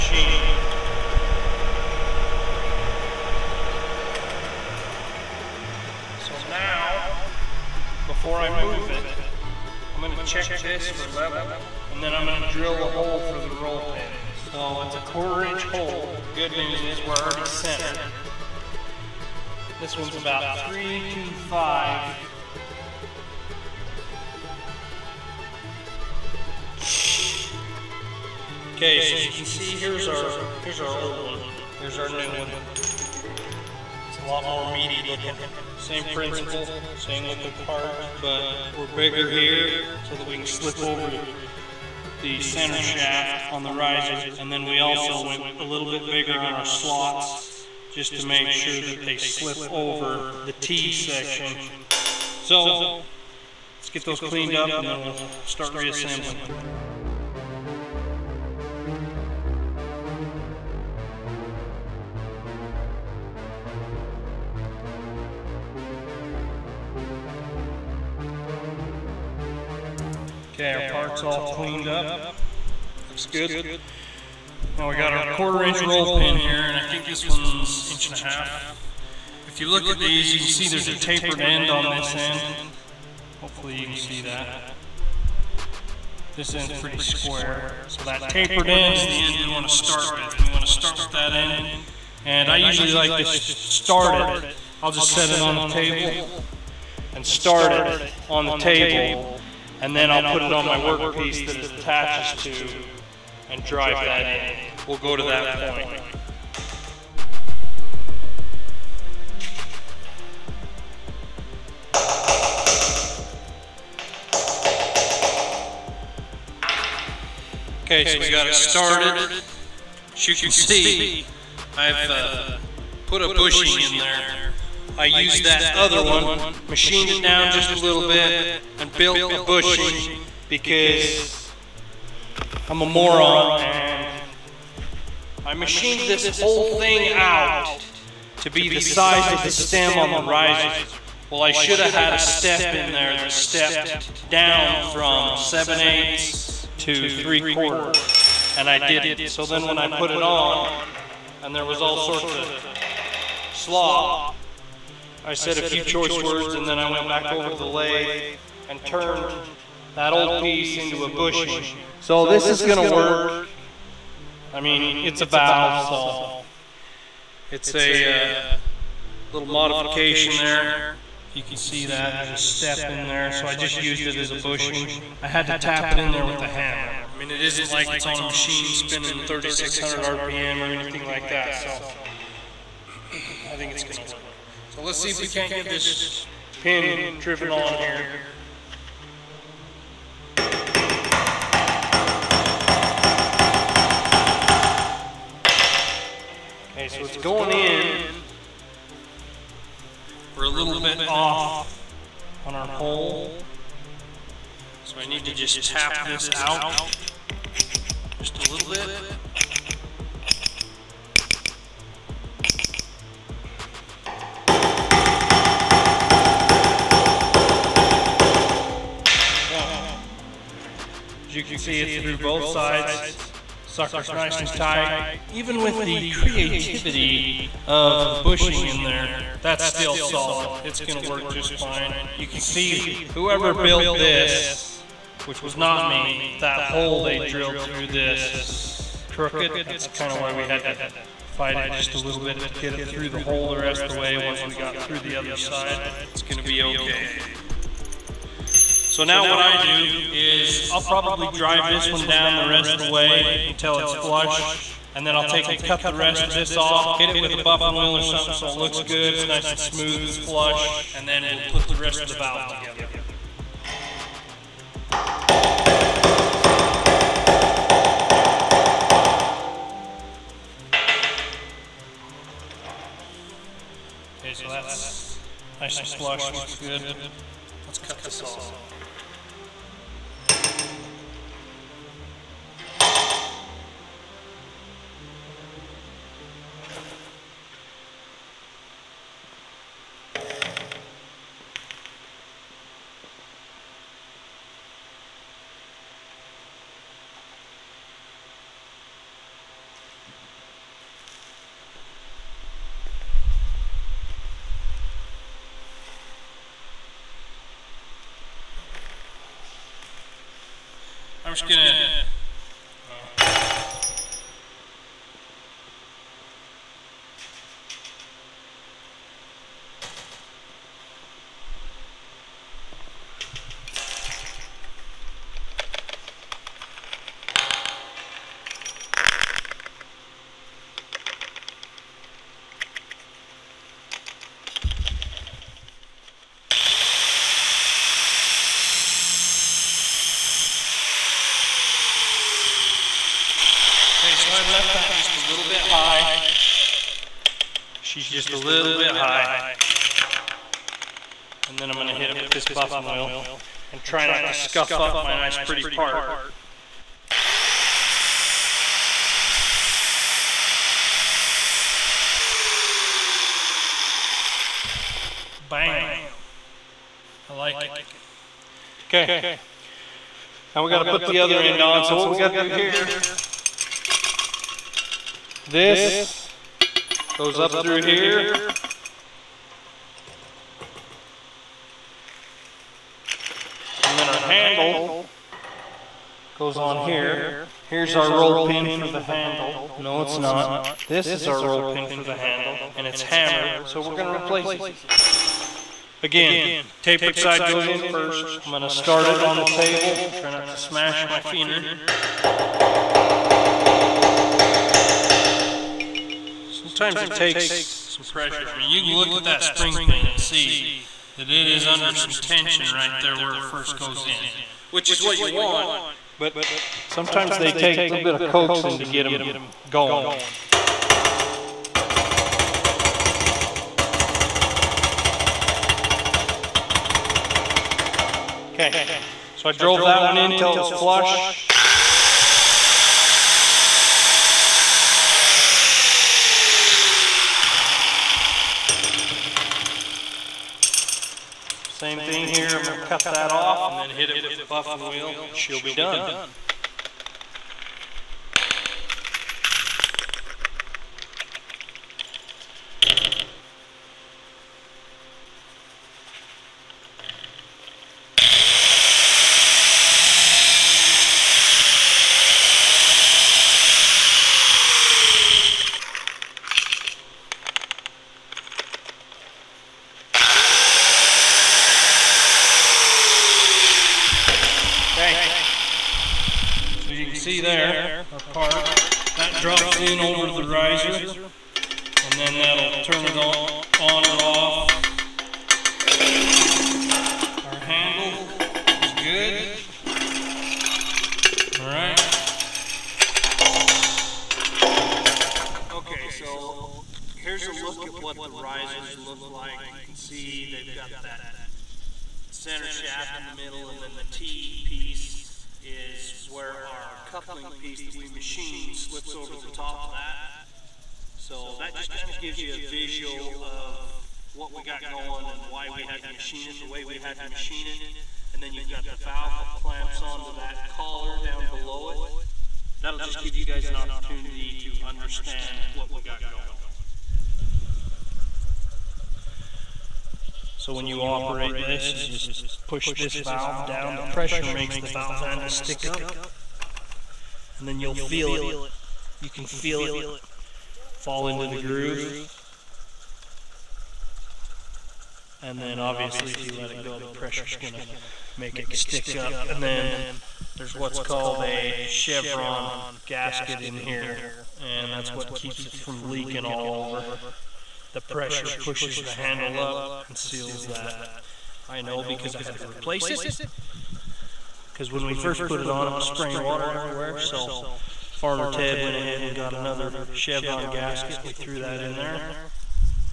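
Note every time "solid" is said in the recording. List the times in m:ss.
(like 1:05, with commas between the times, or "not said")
3:49.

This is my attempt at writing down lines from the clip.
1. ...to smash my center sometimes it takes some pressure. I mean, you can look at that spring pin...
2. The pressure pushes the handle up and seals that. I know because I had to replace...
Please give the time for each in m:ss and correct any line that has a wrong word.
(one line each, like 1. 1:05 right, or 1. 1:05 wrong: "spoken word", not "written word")
1. 6:40 wrong: "finger", not "center"
2. 9:17 right.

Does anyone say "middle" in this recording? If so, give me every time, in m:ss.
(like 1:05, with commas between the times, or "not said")
8:23.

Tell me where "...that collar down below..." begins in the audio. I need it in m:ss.
8:40.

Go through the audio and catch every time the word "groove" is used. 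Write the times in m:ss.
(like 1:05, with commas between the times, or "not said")
9:01.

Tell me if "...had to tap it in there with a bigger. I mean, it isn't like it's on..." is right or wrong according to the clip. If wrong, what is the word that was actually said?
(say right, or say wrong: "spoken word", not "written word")
wrong: "hammer", not "bigger".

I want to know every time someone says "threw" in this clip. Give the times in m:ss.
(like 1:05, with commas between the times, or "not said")
9:31.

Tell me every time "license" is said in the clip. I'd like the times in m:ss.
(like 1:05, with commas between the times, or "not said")
not said.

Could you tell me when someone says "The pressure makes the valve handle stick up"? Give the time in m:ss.
8:53.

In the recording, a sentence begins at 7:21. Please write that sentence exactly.
Same thing here, I'm gonna cut that off and then hit it with the buffing wheel.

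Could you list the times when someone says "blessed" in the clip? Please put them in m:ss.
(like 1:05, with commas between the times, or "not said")
not said.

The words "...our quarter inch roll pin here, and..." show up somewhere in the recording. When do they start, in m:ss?
1:15.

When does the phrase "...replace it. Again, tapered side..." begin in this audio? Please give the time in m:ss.
6:34.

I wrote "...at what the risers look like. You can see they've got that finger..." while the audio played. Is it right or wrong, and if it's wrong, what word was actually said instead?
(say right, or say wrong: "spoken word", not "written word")
wrong: "center", not "finger".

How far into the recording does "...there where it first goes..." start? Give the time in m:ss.
6:52.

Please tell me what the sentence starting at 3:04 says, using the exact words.
So let's see if we can't get this pin driven on here.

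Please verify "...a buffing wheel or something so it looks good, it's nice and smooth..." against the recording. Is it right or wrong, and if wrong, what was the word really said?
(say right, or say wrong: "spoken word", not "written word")
right.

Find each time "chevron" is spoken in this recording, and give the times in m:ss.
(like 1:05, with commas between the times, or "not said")
9:11, 9:30.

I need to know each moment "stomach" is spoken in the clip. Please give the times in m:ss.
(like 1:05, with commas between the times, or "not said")
not said.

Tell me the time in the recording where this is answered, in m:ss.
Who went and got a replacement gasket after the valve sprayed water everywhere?
9:28.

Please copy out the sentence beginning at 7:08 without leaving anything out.
Okay, so I drove that one in till it was flush.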